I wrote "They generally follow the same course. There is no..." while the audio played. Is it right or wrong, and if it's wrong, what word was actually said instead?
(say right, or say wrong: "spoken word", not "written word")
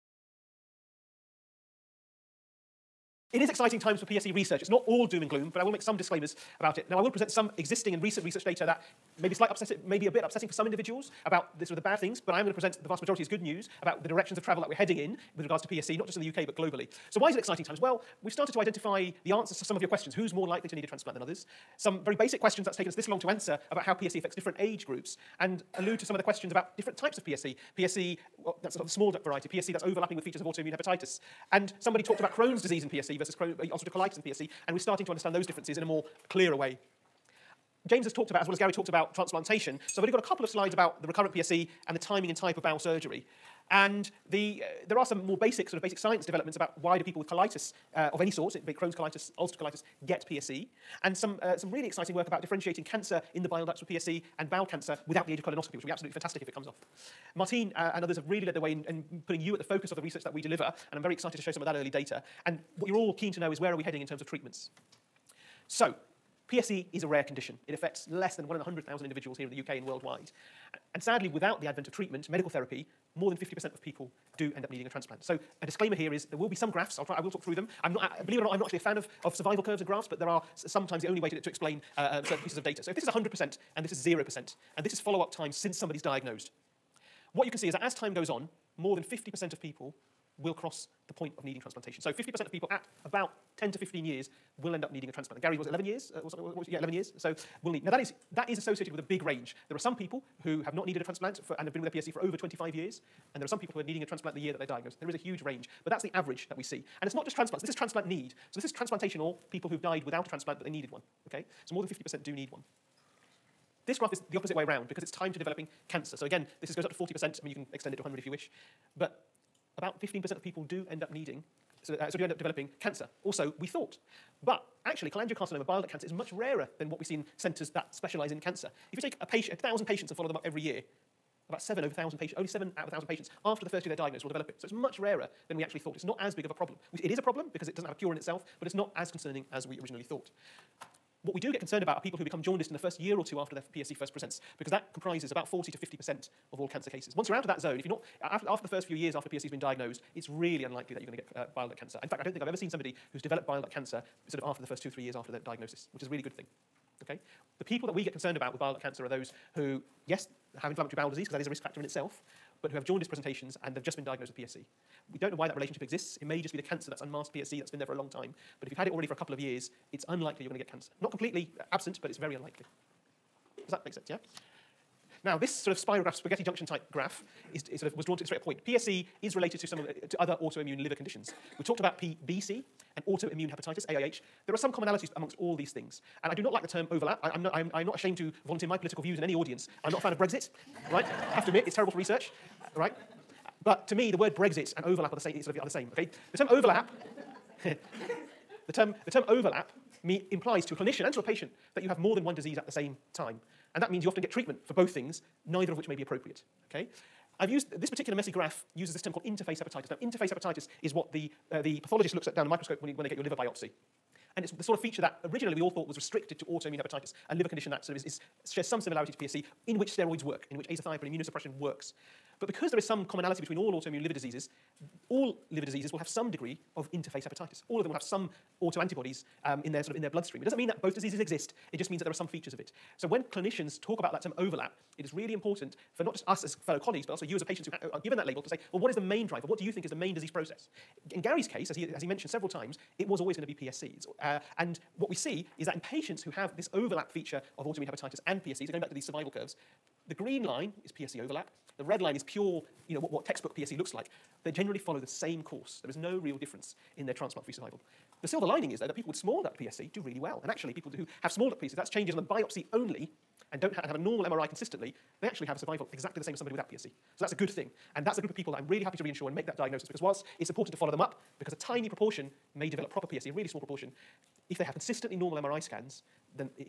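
right.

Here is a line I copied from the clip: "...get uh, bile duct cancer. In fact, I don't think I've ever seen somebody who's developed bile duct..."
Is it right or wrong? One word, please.
right.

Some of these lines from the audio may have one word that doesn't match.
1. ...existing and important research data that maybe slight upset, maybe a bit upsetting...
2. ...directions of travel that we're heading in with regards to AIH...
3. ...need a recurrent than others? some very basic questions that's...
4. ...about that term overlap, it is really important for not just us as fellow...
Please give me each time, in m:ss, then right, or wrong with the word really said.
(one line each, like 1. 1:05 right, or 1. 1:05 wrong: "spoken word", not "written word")
1. 0:07 wrong: "recent", not "important"
2. 0:14 wrong: "PSC", not "AIH"
3. 0:20 wrong: "transplant", not "recurrent"
4. 3:53 right.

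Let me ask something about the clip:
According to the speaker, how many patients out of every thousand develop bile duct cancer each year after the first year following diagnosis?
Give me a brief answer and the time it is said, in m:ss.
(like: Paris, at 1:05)
7, at 2:12.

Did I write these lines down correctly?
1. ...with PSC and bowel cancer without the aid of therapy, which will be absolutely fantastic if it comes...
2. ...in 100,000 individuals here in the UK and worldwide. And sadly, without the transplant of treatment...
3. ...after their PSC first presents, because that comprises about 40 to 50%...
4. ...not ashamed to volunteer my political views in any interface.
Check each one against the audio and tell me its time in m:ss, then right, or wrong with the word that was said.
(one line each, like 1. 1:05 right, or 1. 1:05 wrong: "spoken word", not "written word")
1. 0:53 wrong: "colonoscopy", not "therapy"
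2. 1:08 wrong: "advent", not "transplant"
3. 2:23 right
4. 3:07 wrong: "audience", not "interface".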